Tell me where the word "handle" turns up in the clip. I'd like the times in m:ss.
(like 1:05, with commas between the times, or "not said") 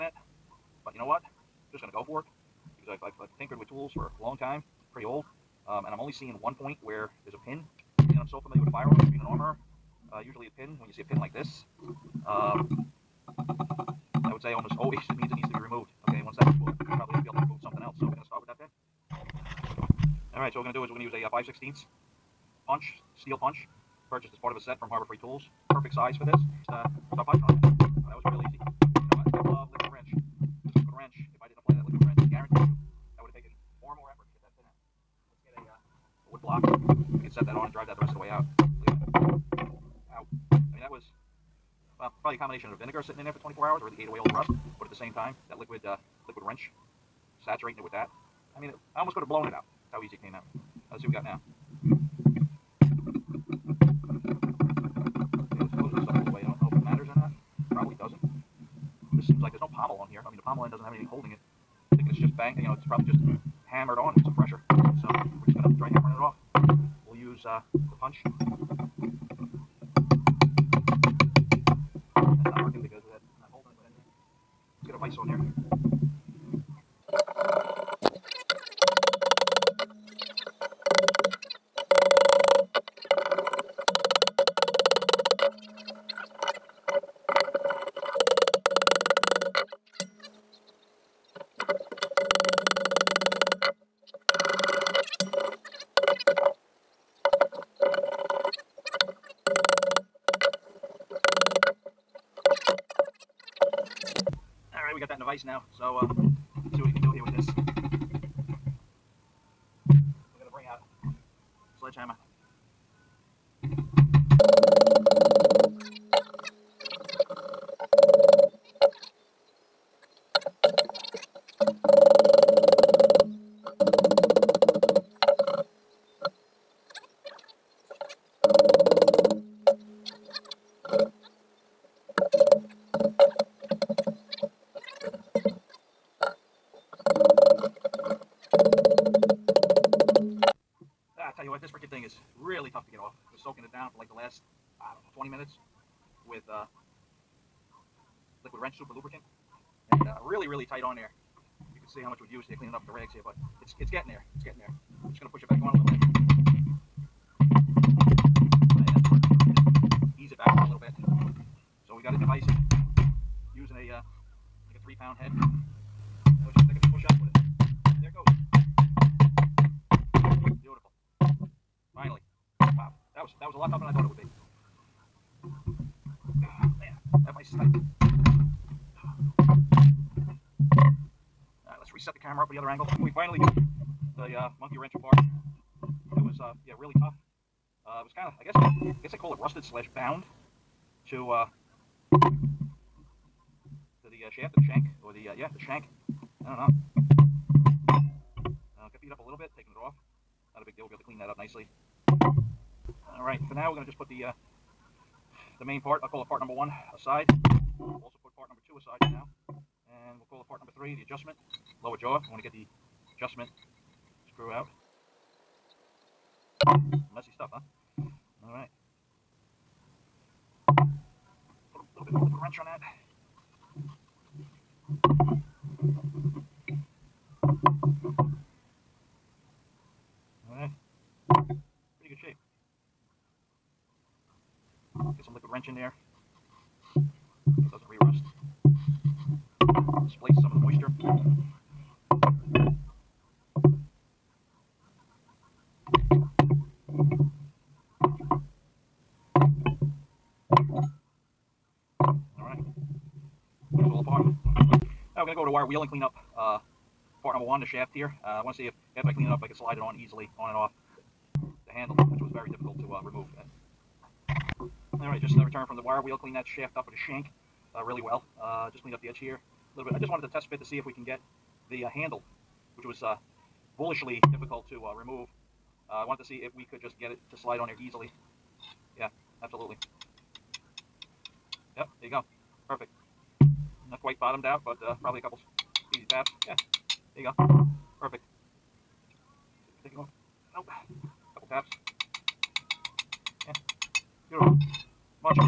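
4:21, 4:31.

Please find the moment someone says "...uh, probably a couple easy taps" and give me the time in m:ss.
4:44.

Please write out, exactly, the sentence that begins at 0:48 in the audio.
I mean, it, I almost could have blown it out.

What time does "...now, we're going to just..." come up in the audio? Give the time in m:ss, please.
3:23.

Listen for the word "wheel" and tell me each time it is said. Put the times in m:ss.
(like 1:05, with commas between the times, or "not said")
4:15, 4:26.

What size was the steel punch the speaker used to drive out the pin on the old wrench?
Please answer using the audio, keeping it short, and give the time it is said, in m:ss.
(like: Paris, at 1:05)
5/16, at 0:21.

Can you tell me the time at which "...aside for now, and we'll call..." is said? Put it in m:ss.
3:28.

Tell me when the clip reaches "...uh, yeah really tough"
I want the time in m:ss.
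3:06.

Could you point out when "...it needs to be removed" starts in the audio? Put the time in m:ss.
0:15.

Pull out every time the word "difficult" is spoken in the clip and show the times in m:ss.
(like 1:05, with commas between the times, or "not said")
4:22, 4:34.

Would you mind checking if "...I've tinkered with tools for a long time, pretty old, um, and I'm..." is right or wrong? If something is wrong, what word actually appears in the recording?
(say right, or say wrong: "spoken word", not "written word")
right.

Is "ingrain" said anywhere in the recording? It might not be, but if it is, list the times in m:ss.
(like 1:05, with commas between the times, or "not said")
not said.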